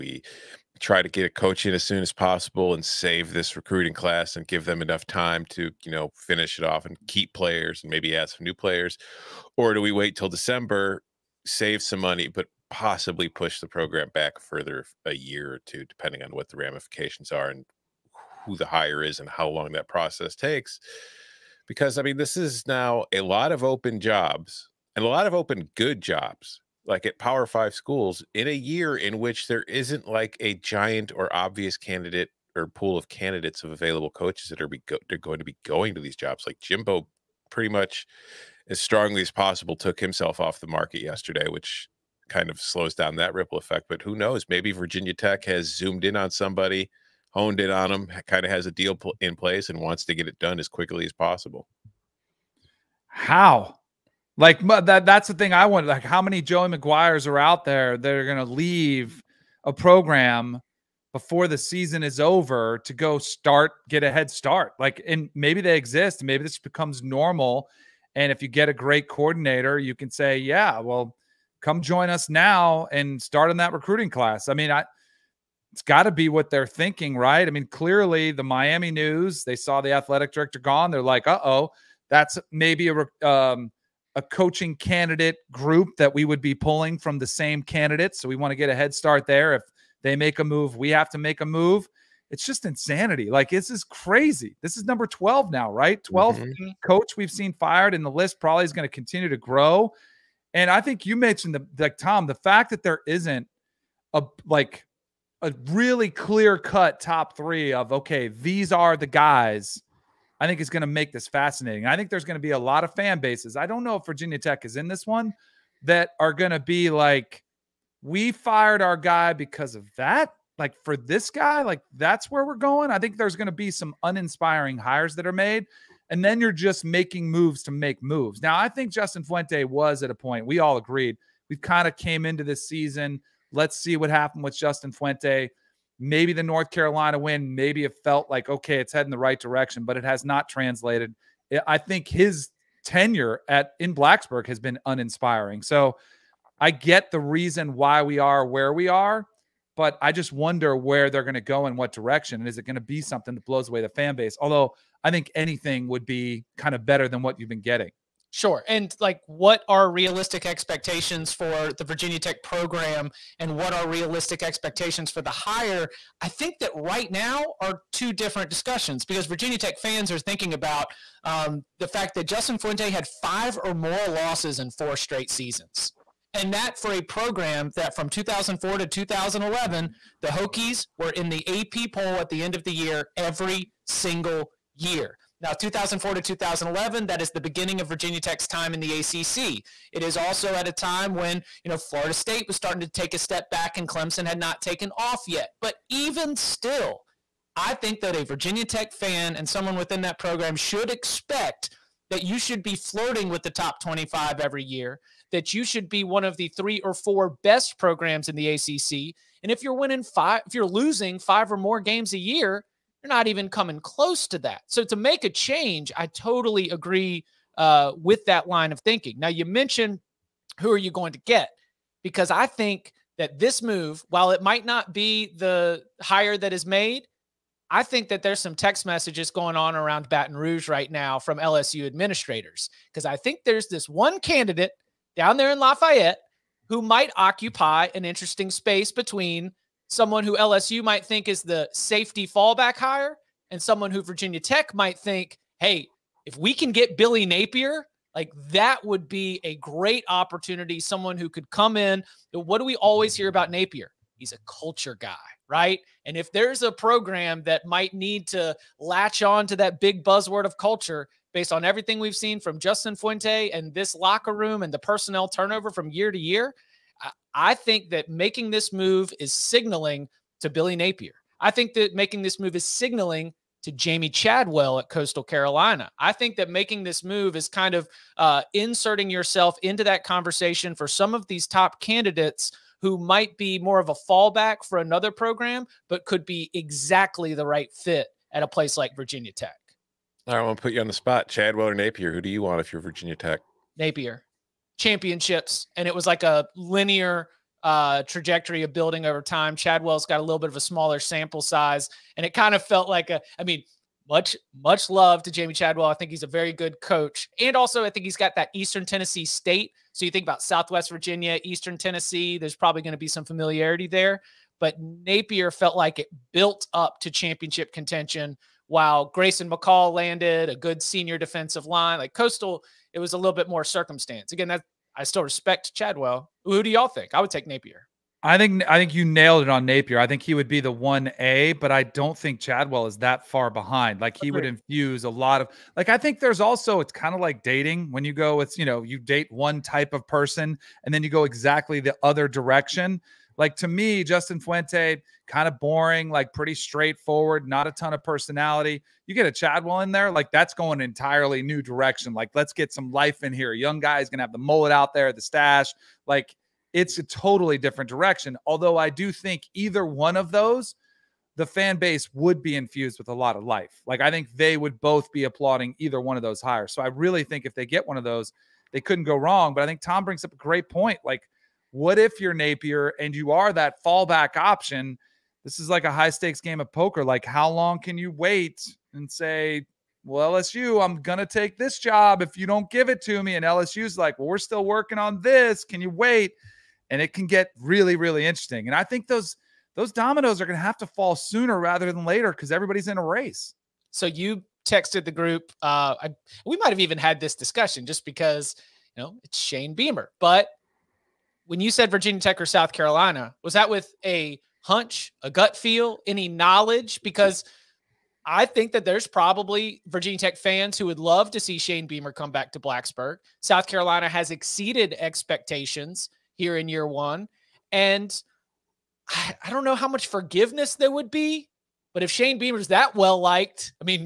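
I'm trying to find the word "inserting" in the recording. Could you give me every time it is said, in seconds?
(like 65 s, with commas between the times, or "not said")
278 s.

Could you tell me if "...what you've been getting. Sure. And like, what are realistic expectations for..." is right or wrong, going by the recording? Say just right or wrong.
right.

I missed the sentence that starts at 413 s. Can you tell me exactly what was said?
South Carolina has exceeded expectations here in year one.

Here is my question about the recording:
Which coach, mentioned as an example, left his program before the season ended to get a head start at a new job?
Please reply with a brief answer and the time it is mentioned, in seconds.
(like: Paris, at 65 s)
Joey McGuire, at 56 s.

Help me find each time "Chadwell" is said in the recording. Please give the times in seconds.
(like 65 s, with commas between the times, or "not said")
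274 s, 291 s, 299 s, 305 s, 325 s, 332 s, 349 s.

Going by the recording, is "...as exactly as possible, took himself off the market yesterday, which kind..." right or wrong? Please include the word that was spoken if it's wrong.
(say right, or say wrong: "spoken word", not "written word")
wrong: "strongly", not "exactly".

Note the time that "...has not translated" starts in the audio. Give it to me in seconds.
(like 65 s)
140 s.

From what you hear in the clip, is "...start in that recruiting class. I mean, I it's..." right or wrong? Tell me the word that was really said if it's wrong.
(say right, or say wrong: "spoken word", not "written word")
right.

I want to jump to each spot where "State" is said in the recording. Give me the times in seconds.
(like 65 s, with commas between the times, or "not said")
192 s, 309 s.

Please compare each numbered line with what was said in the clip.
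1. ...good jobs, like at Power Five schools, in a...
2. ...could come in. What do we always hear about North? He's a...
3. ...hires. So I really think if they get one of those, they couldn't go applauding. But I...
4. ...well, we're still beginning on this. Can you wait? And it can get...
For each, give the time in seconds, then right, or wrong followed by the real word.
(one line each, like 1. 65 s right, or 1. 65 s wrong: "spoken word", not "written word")
1. 25 s right
2. 251 s wrong: "Napier", not "North"
3. 366 s wrong: "wrong", not "applauding"
4. 384 s wrong: "working", not "beginning".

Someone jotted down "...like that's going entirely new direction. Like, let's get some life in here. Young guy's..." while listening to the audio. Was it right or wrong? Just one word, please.
right.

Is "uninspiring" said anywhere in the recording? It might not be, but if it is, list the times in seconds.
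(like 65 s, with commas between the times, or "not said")
124 s, 144 s.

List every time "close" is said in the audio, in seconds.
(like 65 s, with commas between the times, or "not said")
213 s.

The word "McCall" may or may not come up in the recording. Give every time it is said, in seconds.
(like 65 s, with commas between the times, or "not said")
319 s.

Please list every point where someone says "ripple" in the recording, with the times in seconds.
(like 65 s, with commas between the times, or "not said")
43 s.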